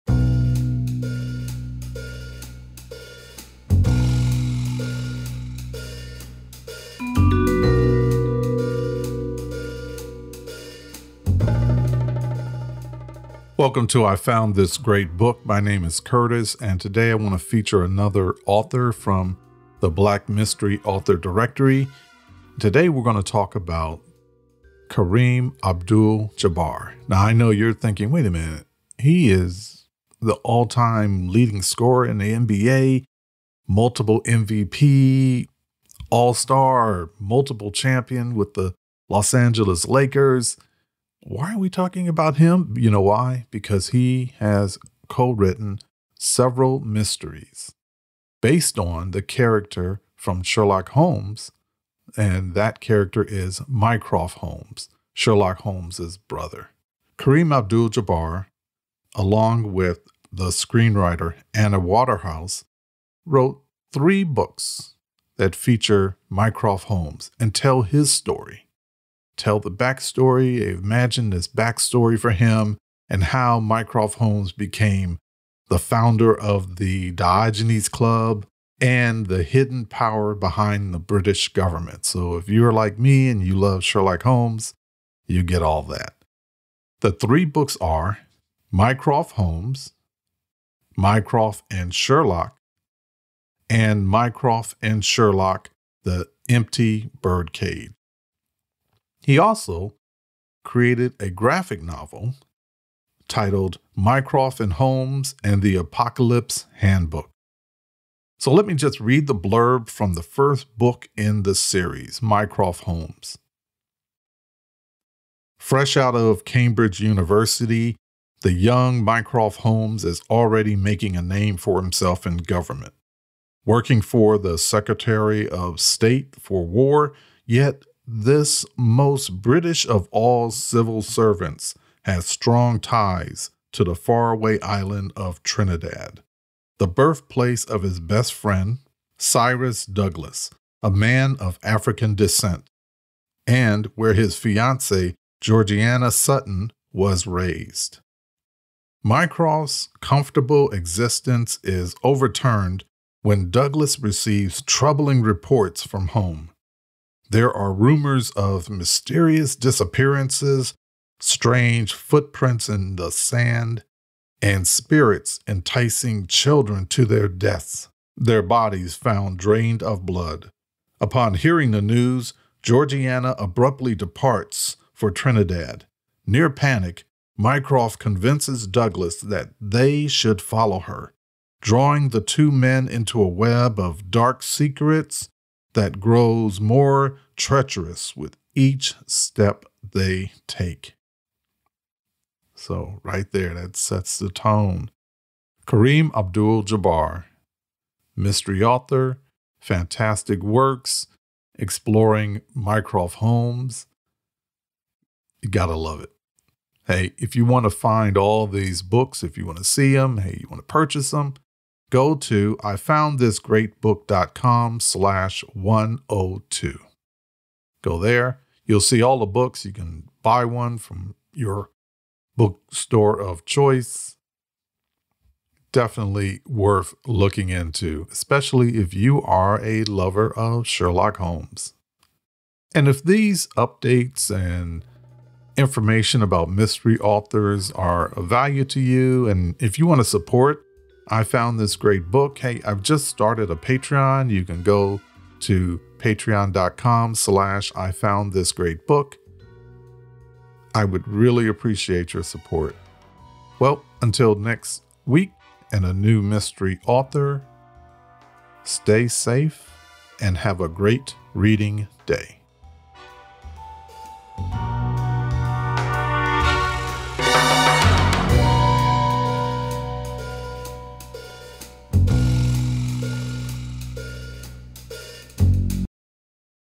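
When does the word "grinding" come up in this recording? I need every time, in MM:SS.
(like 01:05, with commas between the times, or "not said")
not said.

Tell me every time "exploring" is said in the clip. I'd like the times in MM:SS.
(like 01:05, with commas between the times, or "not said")
03:21.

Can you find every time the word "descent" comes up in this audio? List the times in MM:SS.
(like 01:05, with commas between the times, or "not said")
02:22.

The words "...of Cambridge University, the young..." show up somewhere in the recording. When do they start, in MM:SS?
01:56.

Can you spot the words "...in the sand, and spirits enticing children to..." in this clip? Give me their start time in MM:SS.
02:42.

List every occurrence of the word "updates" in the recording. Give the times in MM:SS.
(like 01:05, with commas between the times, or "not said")
03:53.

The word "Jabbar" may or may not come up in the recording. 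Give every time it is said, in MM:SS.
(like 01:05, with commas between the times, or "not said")
00:26, 00:57, 03:16.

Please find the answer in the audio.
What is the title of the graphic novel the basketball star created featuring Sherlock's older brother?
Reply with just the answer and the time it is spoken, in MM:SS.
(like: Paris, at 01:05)
Mycroft and Holmes and the Apocalypse Handbook, at 01:43.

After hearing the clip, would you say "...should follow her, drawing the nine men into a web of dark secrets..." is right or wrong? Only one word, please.
wrong.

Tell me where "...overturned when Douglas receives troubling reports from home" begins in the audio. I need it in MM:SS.
02:32.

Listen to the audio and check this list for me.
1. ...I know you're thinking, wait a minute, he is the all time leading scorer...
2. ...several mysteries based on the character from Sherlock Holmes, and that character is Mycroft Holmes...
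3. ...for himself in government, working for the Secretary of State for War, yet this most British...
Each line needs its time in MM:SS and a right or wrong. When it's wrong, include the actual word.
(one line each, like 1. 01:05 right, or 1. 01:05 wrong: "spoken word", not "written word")
1. 00:27 right
2. 00:46 right
3. 02:01 right.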